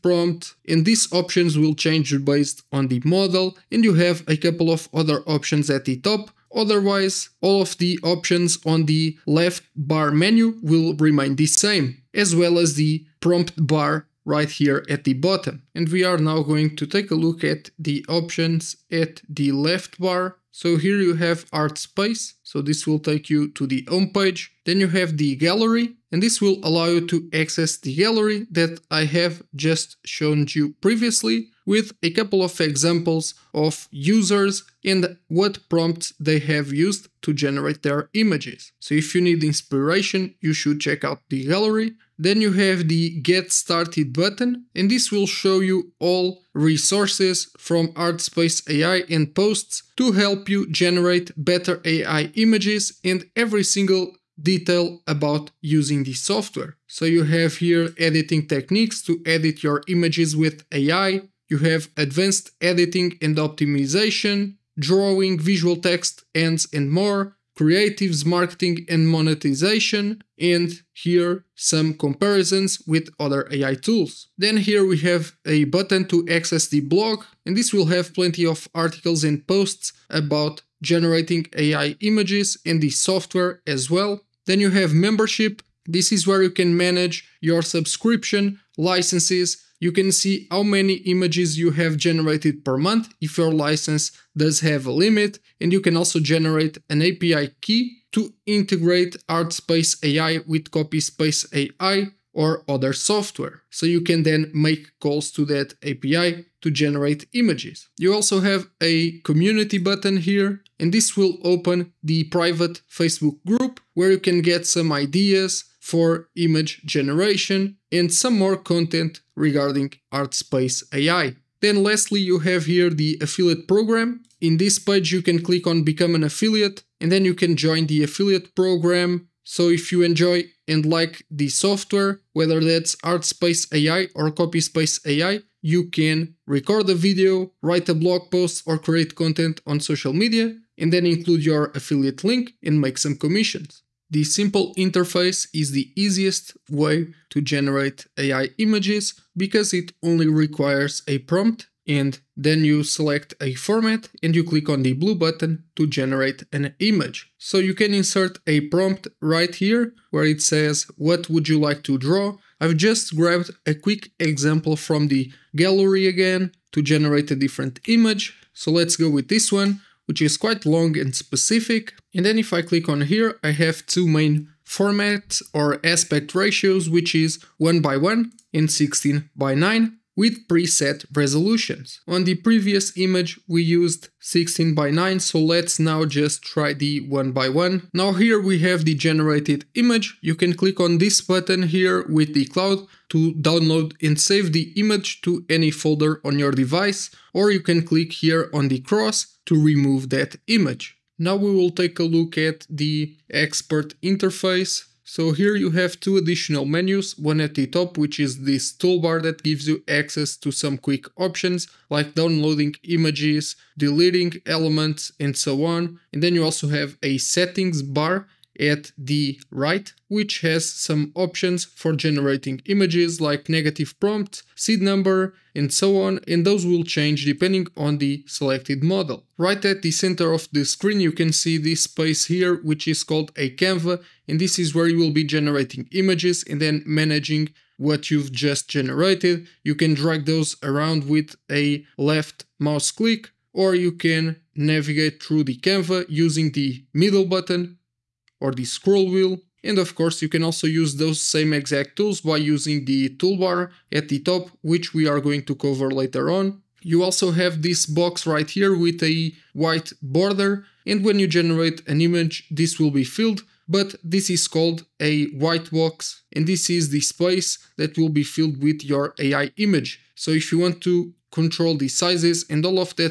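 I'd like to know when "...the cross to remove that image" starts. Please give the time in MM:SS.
03:18.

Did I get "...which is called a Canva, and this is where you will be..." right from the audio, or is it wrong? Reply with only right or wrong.
right.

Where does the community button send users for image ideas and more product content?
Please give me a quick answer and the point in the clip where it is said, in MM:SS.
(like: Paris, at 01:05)
Private Facebook group, at 01:52.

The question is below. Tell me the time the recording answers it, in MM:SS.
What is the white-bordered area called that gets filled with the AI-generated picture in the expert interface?
04:25.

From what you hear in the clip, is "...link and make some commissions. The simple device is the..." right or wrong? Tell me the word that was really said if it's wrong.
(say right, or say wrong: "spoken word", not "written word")
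wrong: "interface", not "device".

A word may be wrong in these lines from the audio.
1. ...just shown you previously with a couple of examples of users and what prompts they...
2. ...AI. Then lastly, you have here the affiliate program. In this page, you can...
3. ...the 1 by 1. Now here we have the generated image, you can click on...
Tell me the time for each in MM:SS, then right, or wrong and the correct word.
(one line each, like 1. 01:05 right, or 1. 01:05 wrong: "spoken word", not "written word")
1. 00:29 right
2. 02:00 right
3. 03:06 right.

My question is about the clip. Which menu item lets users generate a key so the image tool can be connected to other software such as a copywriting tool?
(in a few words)
Membership.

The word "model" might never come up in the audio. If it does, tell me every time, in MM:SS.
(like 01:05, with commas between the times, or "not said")
00:03, 03:48.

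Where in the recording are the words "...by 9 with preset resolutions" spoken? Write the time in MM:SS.
02:59.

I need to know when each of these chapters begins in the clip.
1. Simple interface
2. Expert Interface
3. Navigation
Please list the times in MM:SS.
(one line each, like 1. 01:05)
1. 02:23
2. 03:20
3. 00:14.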